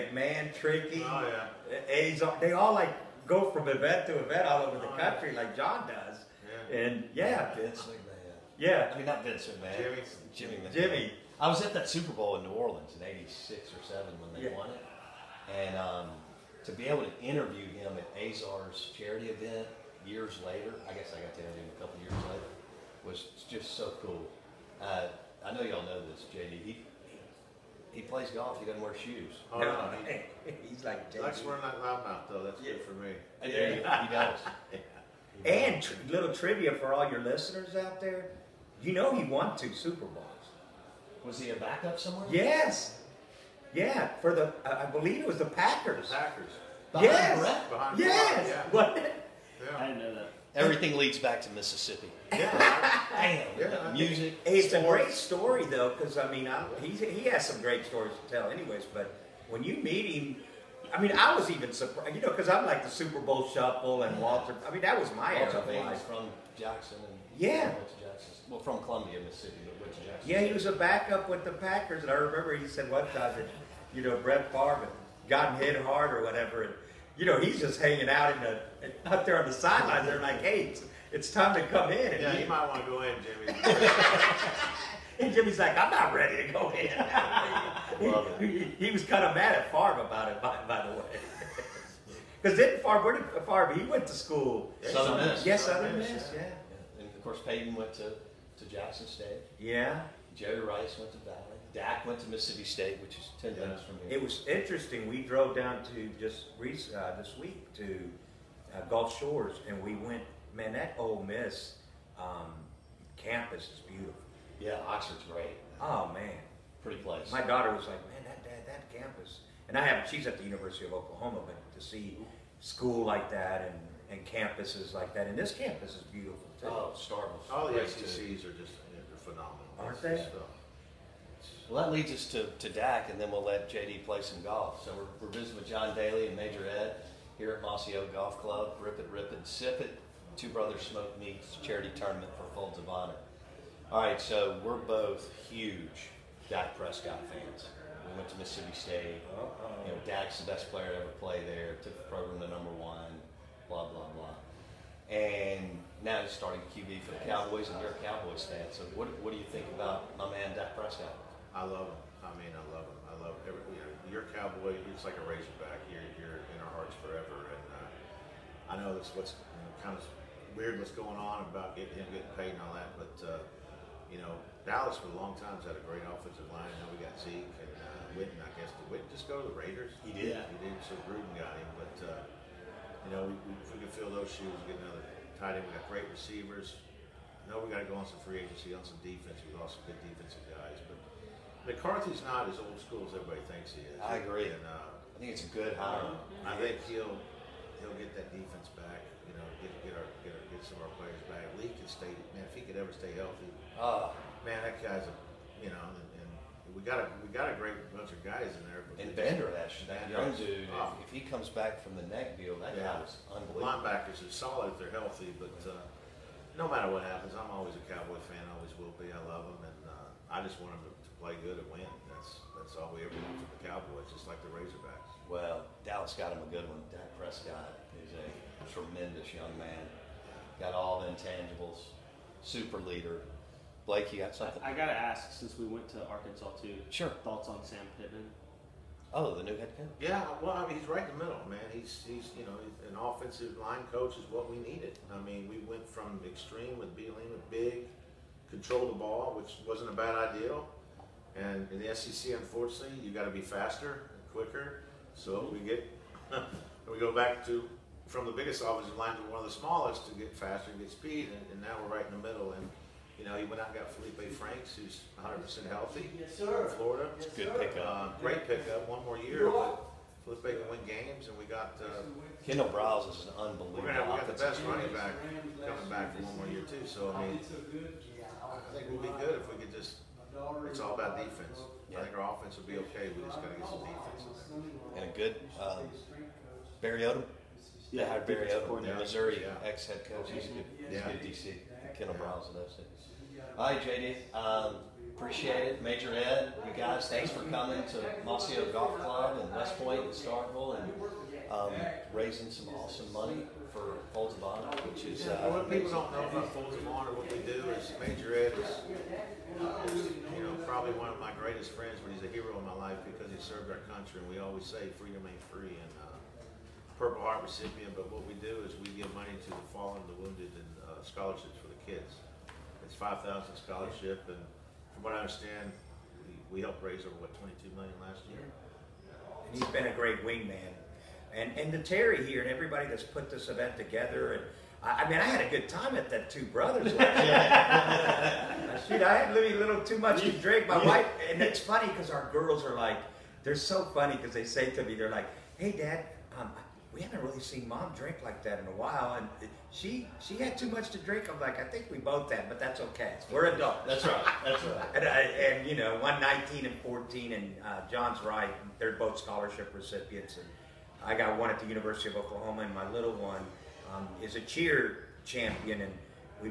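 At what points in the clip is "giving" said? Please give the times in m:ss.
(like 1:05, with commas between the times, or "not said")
not said.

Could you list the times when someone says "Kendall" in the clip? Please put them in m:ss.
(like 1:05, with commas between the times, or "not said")
4:32, 4:51.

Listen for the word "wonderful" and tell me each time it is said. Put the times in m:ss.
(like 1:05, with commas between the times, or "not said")
not said.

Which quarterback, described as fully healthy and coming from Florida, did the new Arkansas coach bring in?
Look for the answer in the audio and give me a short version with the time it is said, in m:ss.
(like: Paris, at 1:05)
Felipe Franks, at 4:23.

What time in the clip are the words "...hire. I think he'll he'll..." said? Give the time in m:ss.
3:15.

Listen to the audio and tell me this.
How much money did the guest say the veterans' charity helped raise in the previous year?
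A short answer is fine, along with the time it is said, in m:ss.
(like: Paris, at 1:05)
22 million, at 5:27.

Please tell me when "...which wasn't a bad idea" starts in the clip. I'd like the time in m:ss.
4:09.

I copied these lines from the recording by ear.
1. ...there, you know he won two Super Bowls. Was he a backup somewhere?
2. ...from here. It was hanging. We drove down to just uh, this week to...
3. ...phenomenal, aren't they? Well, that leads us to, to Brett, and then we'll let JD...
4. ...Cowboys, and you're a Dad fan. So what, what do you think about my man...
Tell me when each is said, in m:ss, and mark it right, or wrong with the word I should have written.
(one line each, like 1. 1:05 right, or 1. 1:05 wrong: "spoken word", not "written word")
1. 0:37 right
2. 1:43 wrong: "interesting", not "hanging"
3. 2:09 wrong: "Dak", not "Brett"
4. 2:37 wrong: "Cowboys", not "Dad".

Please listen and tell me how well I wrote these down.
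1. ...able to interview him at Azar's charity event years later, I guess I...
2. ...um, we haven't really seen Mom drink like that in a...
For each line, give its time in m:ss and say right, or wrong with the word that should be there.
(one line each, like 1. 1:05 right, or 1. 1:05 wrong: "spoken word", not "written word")
1. 0:16 right
2. 5:46 right.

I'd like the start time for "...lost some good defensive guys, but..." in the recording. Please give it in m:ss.
3:09.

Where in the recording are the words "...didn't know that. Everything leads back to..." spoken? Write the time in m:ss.
0:49.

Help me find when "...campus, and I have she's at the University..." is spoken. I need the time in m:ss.
1:58.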